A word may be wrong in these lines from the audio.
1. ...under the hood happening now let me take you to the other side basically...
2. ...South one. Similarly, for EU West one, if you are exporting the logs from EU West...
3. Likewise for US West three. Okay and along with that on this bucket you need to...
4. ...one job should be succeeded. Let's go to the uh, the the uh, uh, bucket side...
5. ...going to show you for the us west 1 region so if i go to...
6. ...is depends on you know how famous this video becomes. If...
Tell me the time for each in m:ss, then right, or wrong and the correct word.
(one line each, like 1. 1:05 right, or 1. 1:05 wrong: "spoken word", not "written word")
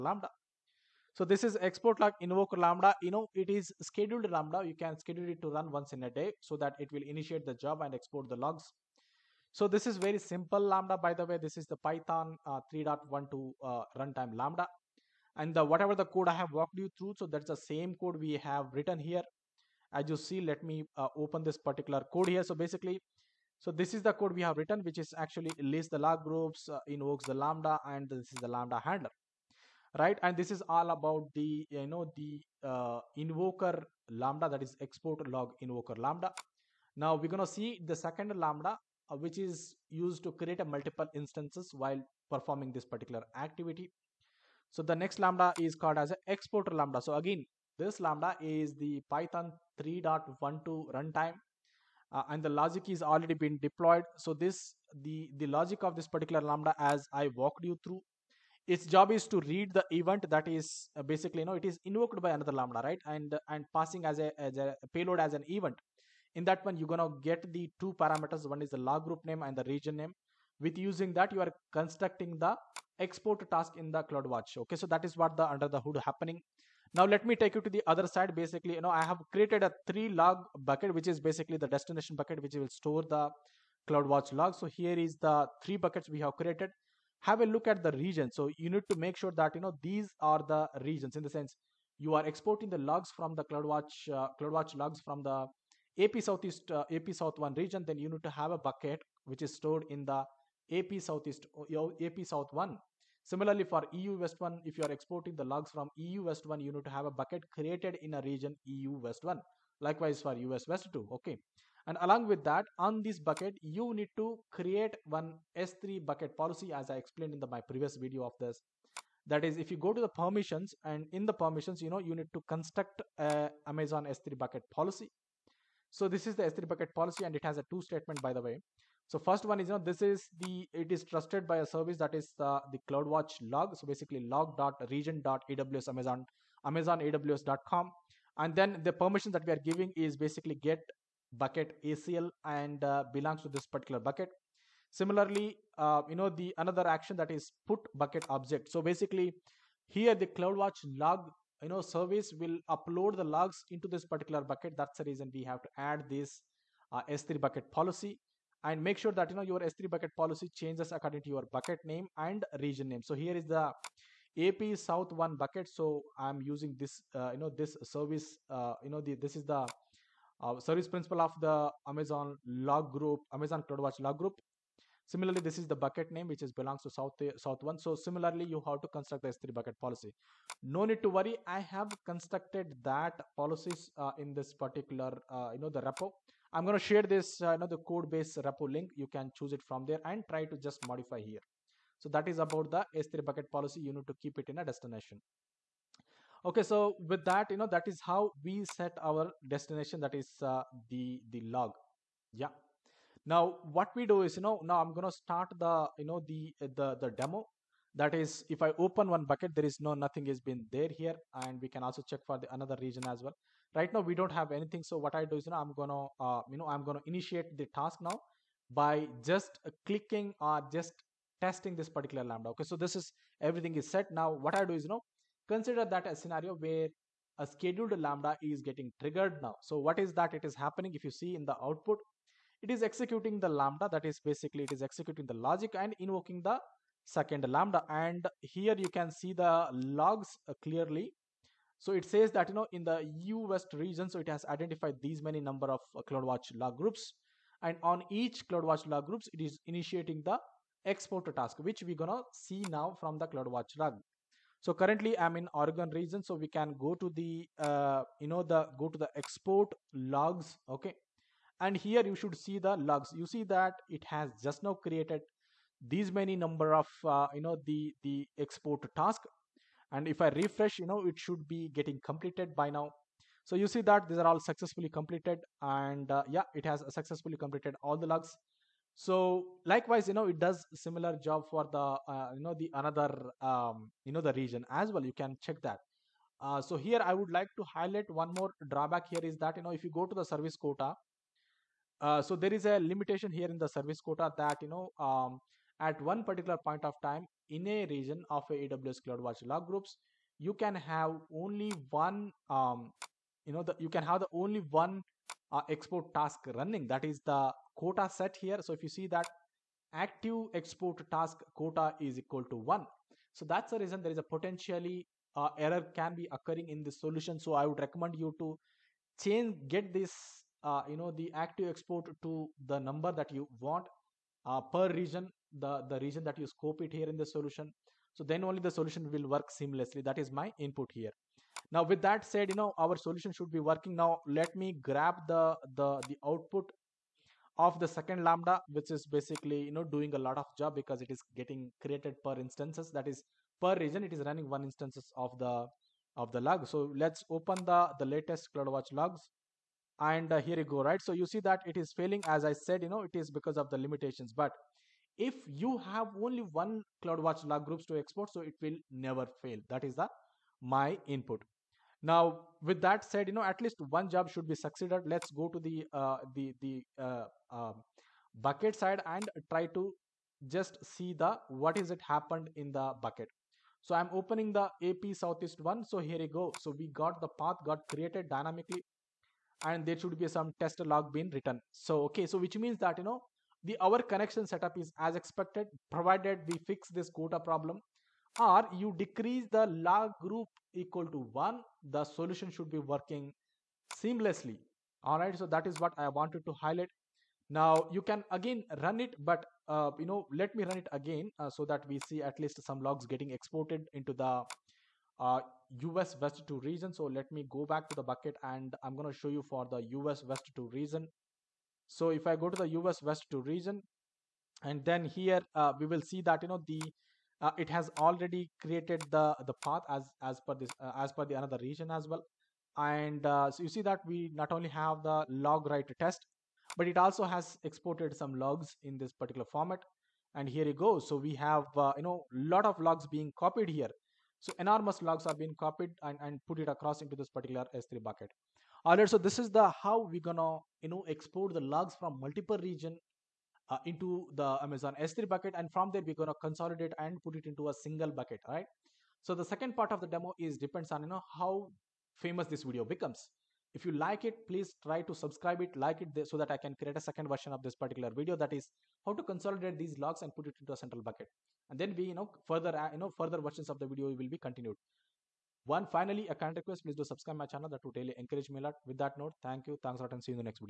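1. 1:15 right
2. 1:42 right
3. 1:49 wrong: "two", not "three"
4. 6:03 right
5. 6:48 wrong: "2", not "1"
6. 7:30 right.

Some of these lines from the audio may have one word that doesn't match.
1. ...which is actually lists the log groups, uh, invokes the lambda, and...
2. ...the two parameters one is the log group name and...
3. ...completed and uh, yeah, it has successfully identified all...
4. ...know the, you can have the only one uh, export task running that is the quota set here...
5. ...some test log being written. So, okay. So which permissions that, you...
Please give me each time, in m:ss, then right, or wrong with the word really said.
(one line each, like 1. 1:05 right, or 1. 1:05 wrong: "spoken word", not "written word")
1. 0:24 right
2. 1:07 right
3. 4:34 wrong: "completed", not "identified"
4. 5:03 right
5. 6:20 wrong: "means", not "permissions".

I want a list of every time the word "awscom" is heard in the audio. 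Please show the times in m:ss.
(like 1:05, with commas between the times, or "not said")
2:17.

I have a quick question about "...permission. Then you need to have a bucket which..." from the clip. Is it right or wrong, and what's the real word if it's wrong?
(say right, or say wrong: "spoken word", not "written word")
wrong: "region", not "permission".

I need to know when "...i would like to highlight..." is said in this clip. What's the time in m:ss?
4:47.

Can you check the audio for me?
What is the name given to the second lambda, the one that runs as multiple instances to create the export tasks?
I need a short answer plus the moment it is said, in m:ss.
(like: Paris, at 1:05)
exporter lambda, at 0:46.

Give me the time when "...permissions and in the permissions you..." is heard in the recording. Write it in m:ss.
2:00.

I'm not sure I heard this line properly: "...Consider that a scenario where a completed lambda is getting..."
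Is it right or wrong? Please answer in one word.
wrong.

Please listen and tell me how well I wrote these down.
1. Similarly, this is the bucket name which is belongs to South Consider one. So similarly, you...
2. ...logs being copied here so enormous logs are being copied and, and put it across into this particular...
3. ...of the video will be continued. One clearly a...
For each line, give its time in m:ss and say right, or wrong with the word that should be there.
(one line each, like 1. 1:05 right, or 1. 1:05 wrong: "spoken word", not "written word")
1. 2:55 wrong: "South", not "Consider"
2. 7:12 right
3. 7:43 wrong: "finally", not "clearly".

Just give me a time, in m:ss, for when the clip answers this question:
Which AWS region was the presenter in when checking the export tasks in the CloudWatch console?
4:15.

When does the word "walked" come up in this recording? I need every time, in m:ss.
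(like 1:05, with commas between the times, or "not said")
0:16, 0:57.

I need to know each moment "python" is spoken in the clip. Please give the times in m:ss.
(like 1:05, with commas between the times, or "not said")
0:11, 0:49.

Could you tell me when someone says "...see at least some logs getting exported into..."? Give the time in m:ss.
6:42.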